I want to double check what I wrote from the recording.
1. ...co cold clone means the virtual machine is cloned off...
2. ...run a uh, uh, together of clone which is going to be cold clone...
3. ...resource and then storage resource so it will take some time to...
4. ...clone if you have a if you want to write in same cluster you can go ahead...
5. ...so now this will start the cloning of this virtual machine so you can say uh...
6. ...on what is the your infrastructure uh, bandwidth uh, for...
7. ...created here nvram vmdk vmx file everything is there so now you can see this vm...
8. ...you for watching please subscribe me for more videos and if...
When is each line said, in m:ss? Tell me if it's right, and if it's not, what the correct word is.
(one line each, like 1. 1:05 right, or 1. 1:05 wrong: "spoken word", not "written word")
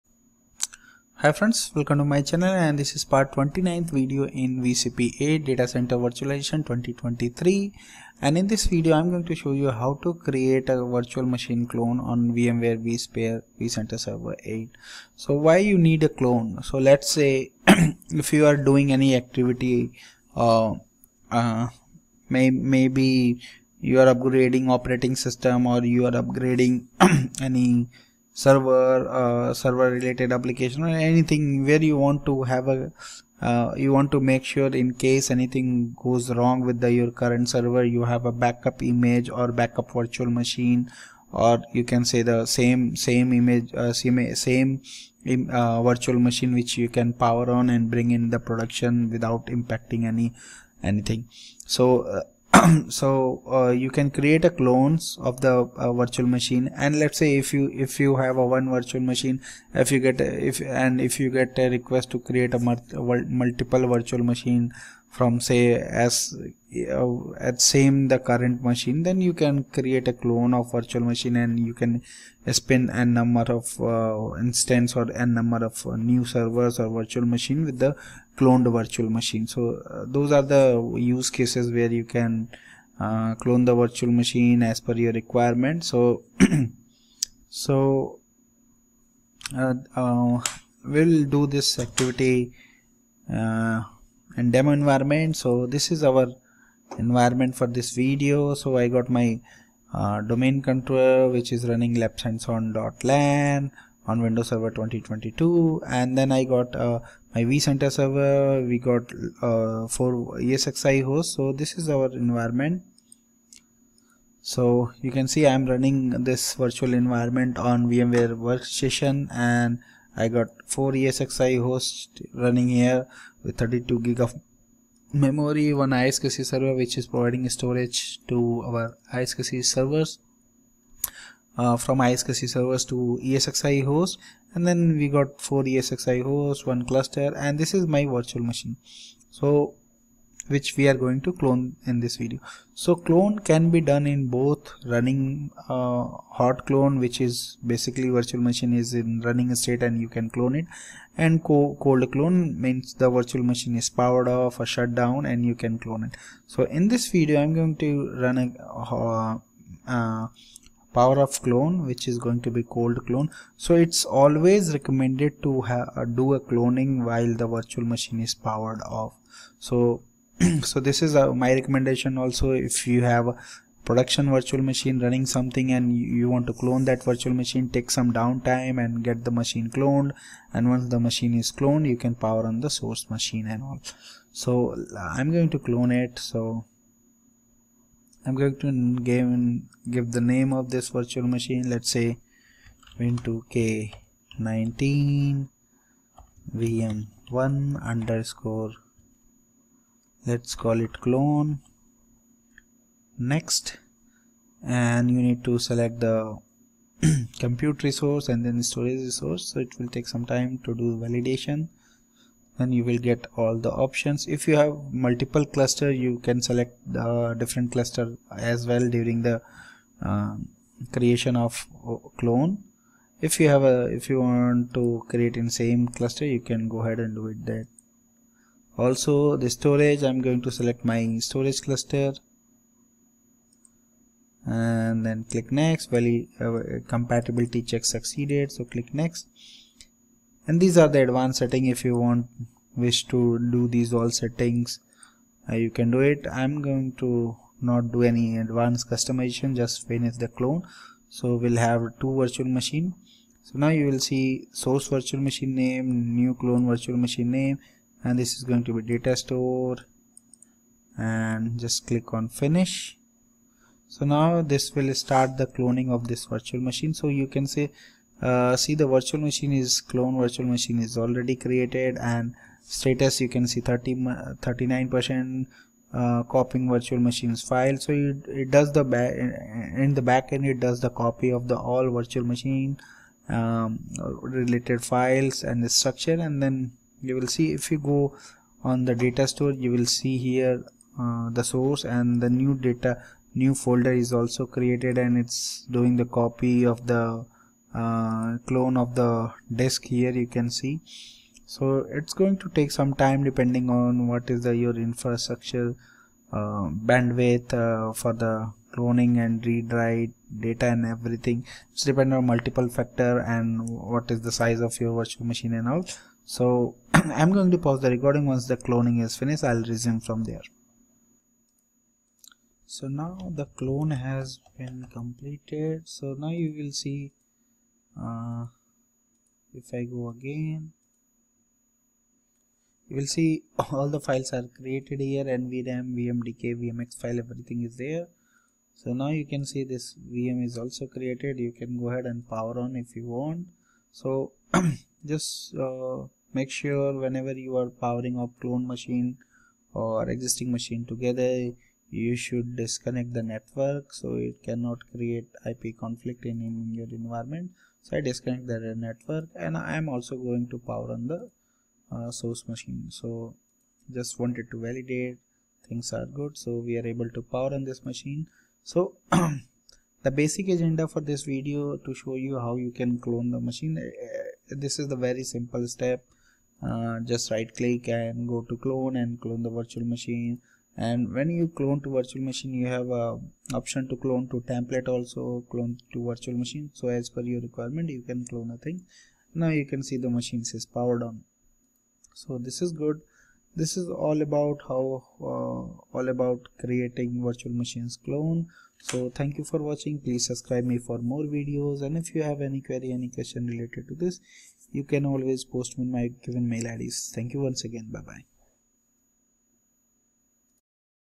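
1. 2:31 wrong: "powered", not "cloned"
2. 2:38 wrong: "power", not "together"
3. 3:27 right
4. 3:42 wrong: "create", not "write"
5. 4:23 right
6. 5:03 right
7. 5:34 right
8. 6:39 right.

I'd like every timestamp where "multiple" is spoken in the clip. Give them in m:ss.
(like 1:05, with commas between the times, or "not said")
1:03, 3:34, 5:12.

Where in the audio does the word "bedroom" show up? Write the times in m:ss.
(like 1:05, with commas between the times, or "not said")
not said.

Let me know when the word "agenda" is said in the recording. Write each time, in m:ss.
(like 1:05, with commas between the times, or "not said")
6:10.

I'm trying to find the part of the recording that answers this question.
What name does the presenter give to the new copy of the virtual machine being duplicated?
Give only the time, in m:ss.
3:12.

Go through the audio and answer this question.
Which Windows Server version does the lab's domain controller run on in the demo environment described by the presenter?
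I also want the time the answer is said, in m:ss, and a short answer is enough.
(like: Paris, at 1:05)
Windows Server 2022, at 1:44.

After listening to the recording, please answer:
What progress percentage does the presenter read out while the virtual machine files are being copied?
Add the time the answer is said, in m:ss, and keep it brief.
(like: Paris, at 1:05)
39%, at 4:34.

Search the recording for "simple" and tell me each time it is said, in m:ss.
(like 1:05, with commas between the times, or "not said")
6:15.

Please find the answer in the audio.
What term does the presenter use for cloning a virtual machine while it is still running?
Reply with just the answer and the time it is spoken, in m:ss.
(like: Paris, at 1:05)
Hot clone, at 2:26.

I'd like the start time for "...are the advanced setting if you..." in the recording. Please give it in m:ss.
4:00.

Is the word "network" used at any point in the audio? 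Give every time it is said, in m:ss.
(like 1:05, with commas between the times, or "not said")
5:53, 5:58.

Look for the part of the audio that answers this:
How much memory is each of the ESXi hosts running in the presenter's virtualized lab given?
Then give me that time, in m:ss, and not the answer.
2:03.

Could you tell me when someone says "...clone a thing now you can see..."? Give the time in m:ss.
6:28.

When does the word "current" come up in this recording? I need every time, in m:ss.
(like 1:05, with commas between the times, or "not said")
0:37, 1:08.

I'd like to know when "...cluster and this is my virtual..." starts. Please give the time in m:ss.
2:16.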